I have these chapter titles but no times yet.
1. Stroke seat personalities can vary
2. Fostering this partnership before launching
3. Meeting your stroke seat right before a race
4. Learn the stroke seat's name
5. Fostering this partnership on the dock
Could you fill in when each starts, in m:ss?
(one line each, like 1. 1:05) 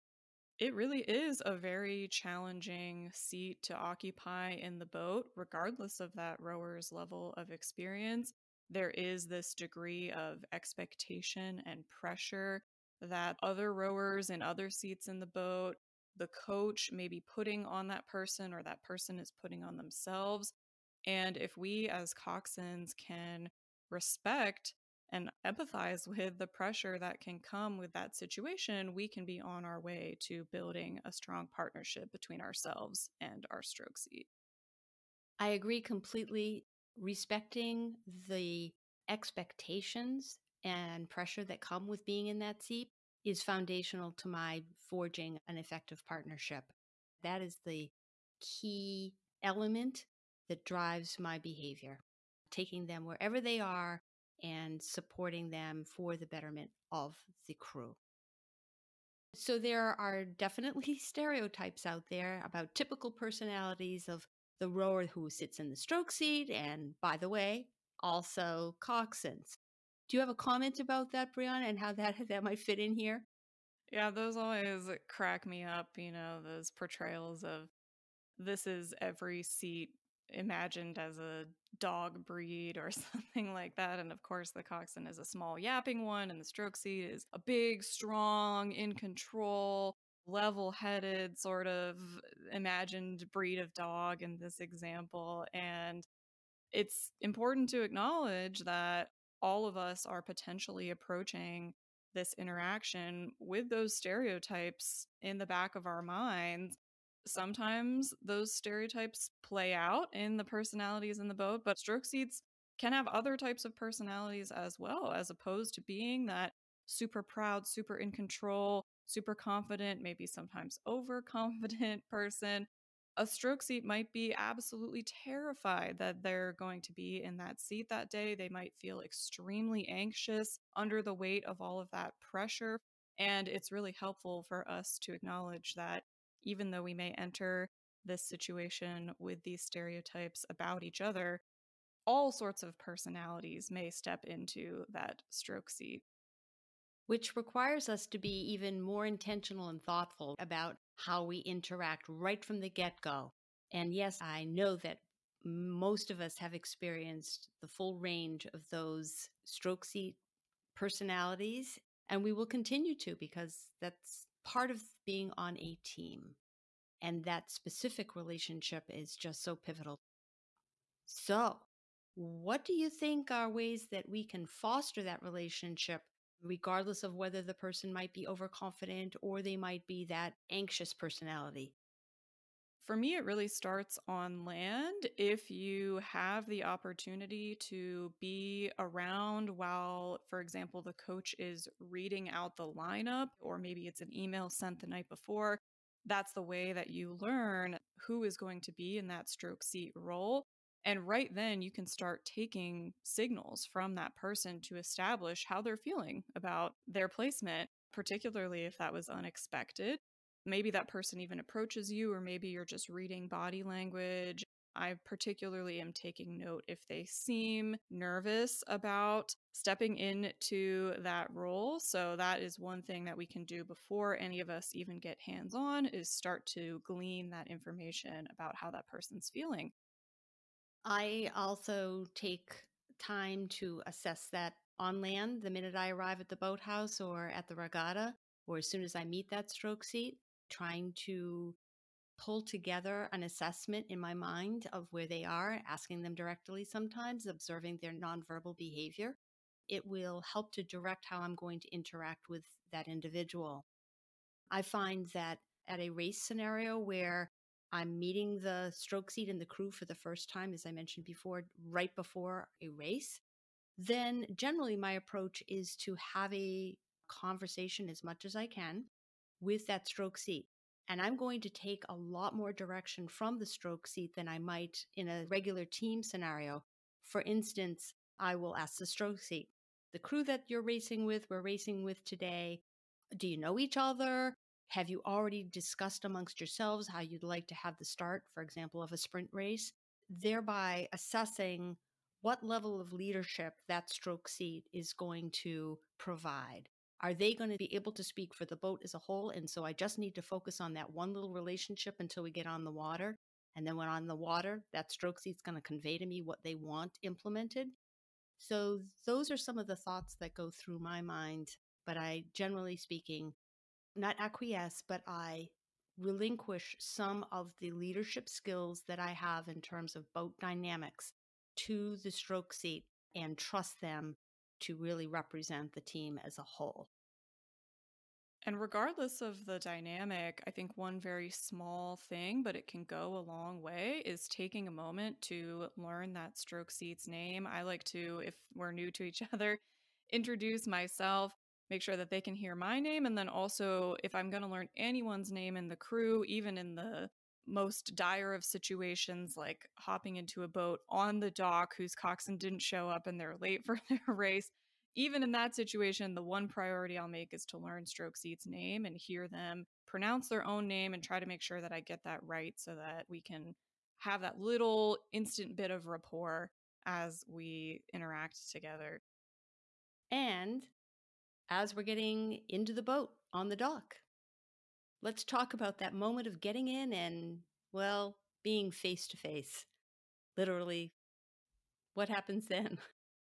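1. 0:58
2. 2:51
3. 4:13
4. 5:27
5. 6:09.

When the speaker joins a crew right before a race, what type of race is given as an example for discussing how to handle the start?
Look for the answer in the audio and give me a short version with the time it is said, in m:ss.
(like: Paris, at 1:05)
sprint race, at 4:48.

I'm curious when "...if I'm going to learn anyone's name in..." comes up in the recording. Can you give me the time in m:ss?
5:44.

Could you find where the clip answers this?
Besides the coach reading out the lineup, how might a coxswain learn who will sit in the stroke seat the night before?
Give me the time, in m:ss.
3:14.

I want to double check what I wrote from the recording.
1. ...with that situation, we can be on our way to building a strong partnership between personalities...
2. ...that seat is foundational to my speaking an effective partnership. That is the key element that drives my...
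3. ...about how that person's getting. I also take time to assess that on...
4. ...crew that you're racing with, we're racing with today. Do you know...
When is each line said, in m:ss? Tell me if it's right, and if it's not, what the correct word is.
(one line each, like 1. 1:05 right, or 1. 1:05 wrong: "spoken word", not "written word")
1. 0:27 wrong: "ourselves", not "personalities"
2. 0:42 wrong: "forging", not "speaking"
3. 3:48 wrong: "feeling", not "getting"
4. 4:39 right.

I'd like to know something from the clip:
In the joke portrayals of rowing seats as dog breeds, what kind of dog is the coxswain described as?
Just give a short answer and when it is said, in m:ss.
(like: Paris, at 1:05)
small, yapping one, at 1:25.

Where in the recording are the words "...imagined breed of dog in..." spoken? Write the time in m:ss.
1:32.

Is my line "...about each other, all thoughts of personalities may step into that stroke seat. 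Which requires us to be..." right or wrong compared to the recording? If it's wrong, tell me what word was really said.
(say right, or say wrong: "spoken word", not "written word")
wrong: "sorts", not "thoughts".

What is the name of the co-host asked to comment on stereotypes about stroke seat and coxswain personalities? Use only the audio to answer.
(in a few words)
Brianna.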